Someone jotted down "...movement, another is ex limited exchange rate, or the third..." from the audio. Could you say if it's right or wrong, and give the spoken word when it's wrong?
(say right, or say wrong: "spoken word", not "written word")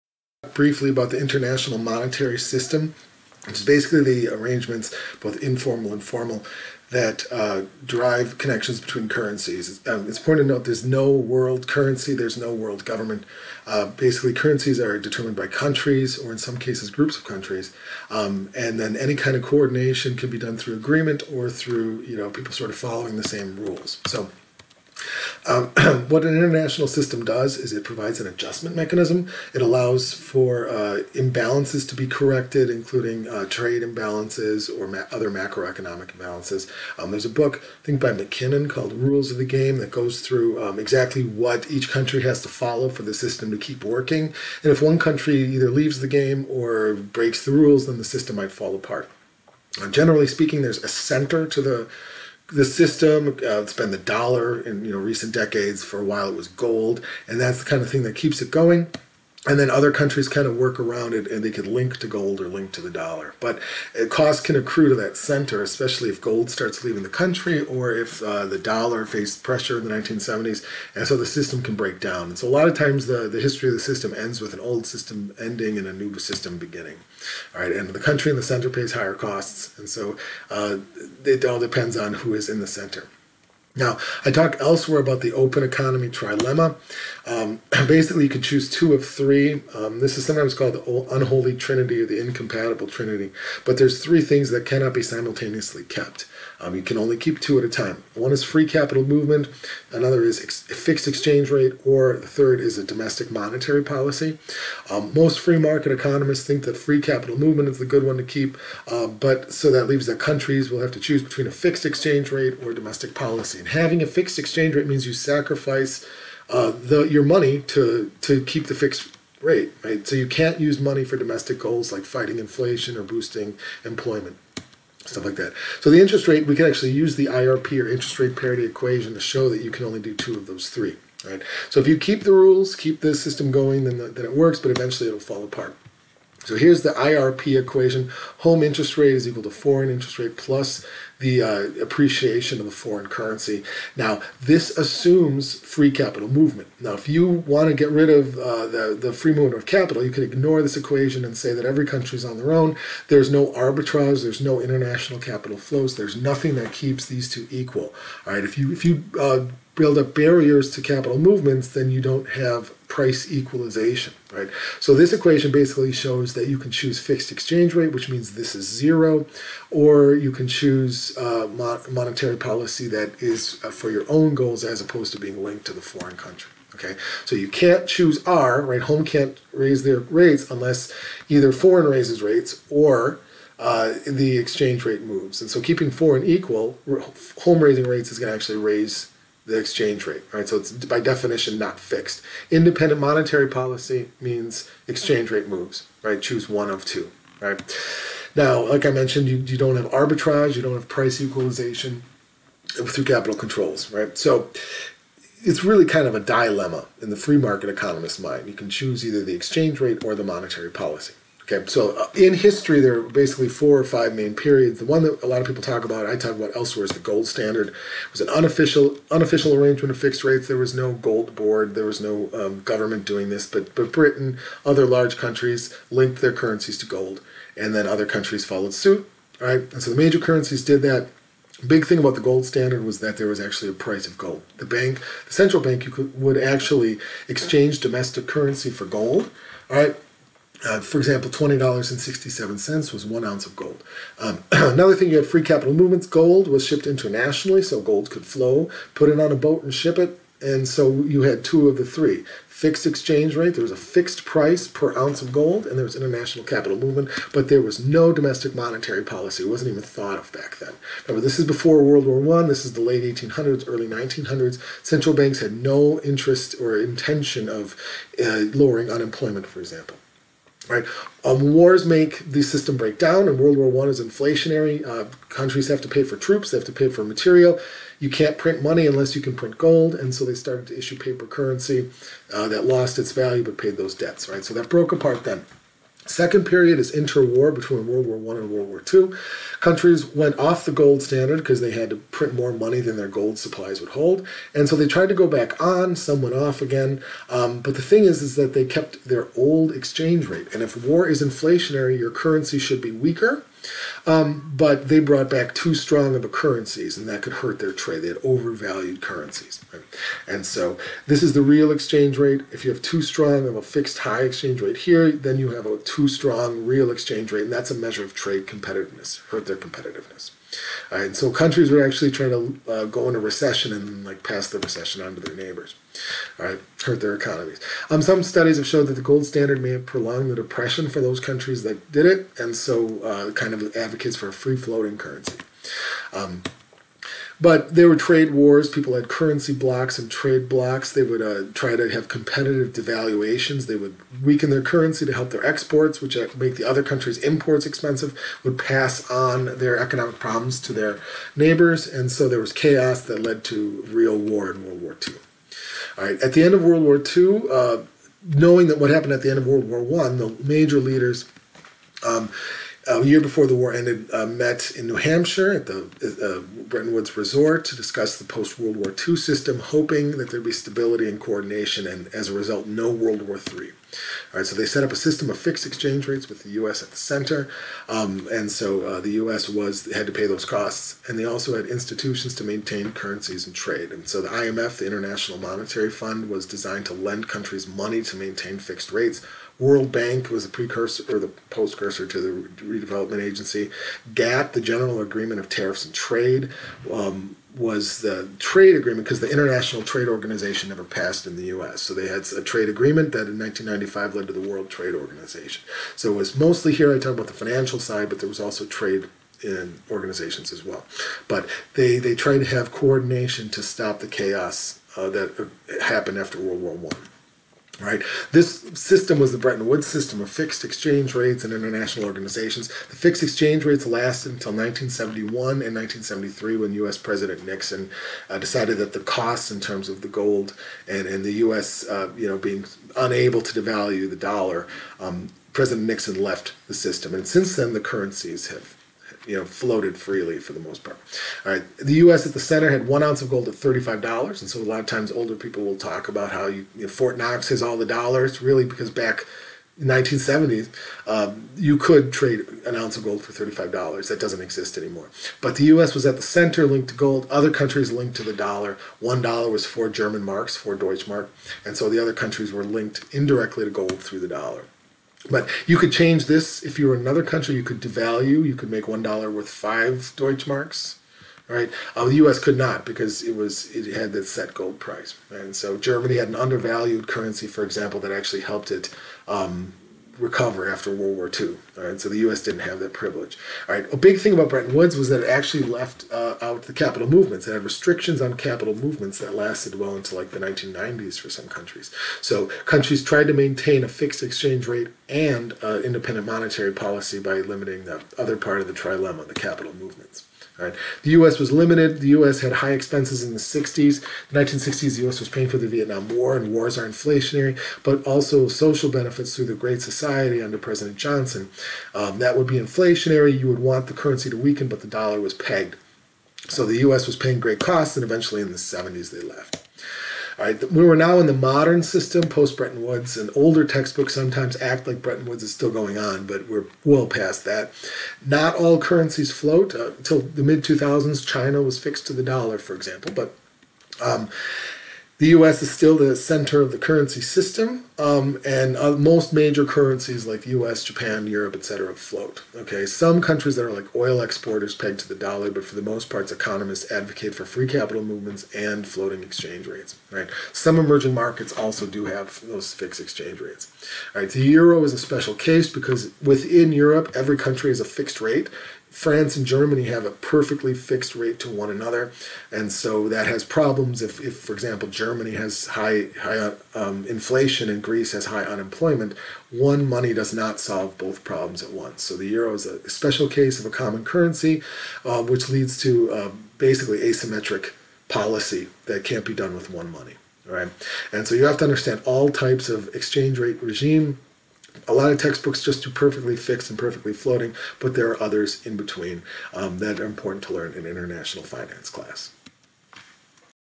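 wrong: "fixed", not "limited".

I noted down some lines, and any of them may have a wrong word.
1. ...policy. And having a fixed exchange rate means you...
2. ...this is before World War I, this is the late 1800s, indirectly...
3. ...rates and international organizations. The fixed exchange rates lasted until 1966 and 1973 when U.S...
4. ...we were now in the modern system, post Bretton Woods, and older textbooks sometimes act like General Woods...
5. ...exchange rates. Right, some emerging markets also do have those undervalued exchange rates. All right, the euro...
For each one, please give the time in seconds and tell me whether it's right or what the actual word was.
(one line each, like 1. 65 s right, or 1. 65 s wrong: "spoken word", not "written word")
1. 113 s right
2. 261 s wrong: "early", not "indirectly"
3. 421 s wrong: "1971", not "1966"
4. 520 s wrong: "Bretton", not "General"
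5. 549 s wrong: "fixed", not "undervalued".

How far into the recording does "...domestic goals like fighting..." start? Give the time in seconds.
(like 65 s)
121 s.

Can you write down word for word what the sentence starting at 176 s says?
Okay, so you can't choose R, right?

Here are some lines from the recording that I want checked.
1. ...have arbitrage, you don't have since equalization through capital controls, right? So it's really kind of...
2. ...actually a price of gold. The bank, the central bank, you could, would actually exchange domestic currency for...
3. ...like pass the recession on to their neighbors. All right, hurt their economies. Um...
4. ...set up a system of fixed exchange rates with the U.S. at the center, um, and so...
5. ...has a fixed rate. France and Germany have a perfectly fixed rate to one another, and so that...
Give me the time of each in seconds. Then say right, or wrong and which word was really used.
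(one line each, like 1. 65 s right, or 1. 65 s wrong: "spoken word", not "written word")
1. 199 s wrong: "price", not "since"
2. 233 s right
3. 324 s right
4. 374 s right
5. 557 s right.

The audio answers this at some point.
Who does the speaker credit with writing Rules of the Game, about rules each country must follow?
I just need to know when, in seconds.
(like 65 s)
38 s.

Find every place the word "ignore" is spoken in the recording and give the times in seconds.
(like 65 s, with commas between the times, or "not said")
150 s.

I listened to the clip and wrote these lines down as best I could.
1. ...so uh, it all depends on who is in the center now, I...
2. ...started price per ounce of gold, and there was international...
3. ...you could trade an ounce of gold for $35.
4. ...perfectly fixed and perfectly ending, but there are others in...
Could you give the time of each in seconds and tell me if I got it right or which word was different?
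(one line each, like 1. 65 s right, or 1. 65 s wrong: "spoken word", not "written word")
1. 79 s right
2. 253 s wrong: "fixed", not "started"
3. 451 s right
4. 585 s wrong: "floating", not "ending".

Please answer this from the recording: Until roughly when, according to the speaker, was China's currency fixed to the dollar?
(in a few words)
mid 2000s.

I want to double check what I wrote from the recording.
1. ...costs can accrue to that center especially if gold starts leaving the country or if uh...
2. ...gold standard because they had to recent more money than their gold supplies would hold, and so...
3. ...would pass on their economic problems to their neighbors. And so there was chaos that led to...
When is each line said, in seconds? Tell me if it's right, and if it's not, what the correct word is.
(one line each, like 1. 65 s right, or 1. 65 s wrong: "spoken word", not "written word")
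1. 64 s right
2. 290 s wrong: "print", not "recent"
3. 348 s right.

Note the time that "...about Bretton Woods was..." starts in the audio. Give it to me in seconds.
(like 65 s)
484 s.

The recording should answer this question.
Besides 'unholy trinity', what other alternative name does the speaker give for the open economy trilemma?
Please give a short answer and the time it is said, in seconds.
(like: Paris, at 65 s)
incompatible trinity, at 92 s.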